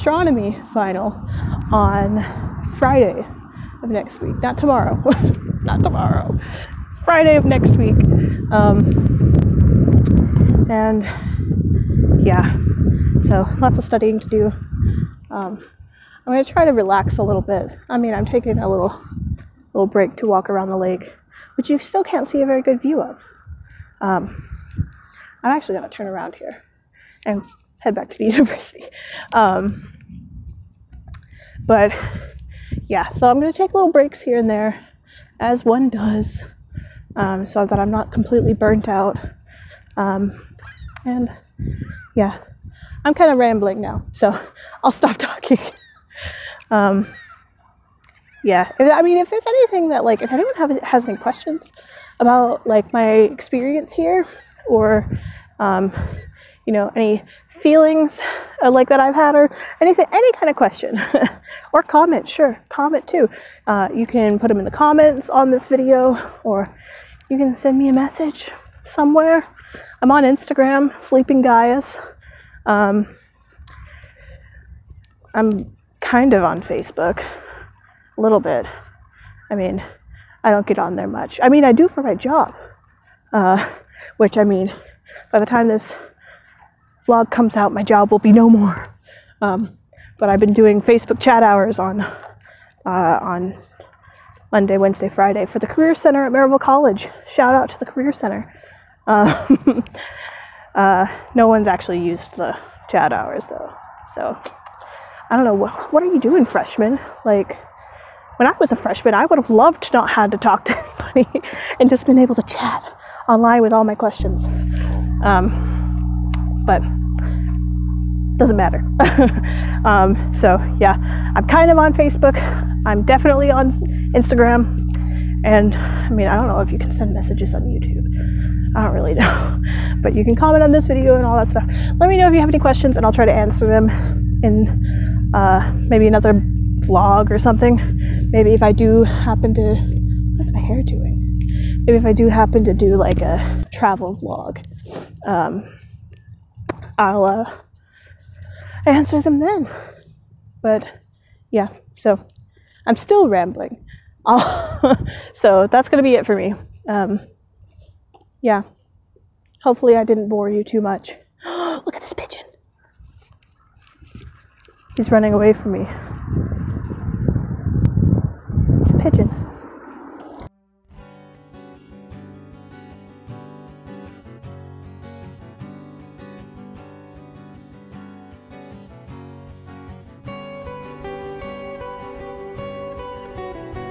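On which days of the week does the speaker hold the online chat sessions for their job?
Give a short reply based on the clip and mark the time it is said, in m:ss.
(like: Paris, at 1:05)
Monday, Wednesday, Friday, at 1:34.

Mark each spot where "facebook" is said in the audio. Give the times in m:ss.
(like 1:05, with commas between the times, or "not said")
1:16, 1:30, 2:01.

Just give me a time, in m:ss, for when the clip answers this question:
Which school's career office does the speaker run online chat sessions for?
1:36.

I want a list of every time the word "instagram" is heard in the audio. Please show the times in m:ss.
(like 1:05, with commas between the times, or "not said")
1:10, 2:04.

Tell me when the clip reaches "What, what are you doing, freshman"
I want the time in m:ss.
1:45.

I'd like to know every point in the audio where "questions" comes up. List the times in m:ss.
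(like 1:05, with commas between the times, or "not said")
0:51, 1:00, 1:53, 2:12.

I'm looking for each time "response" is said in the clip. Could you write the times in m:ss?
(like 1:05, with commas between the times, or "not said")
not said.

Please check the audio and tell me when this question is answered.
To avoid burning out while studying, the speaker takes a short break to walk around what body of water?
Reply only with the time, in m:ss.
0:20.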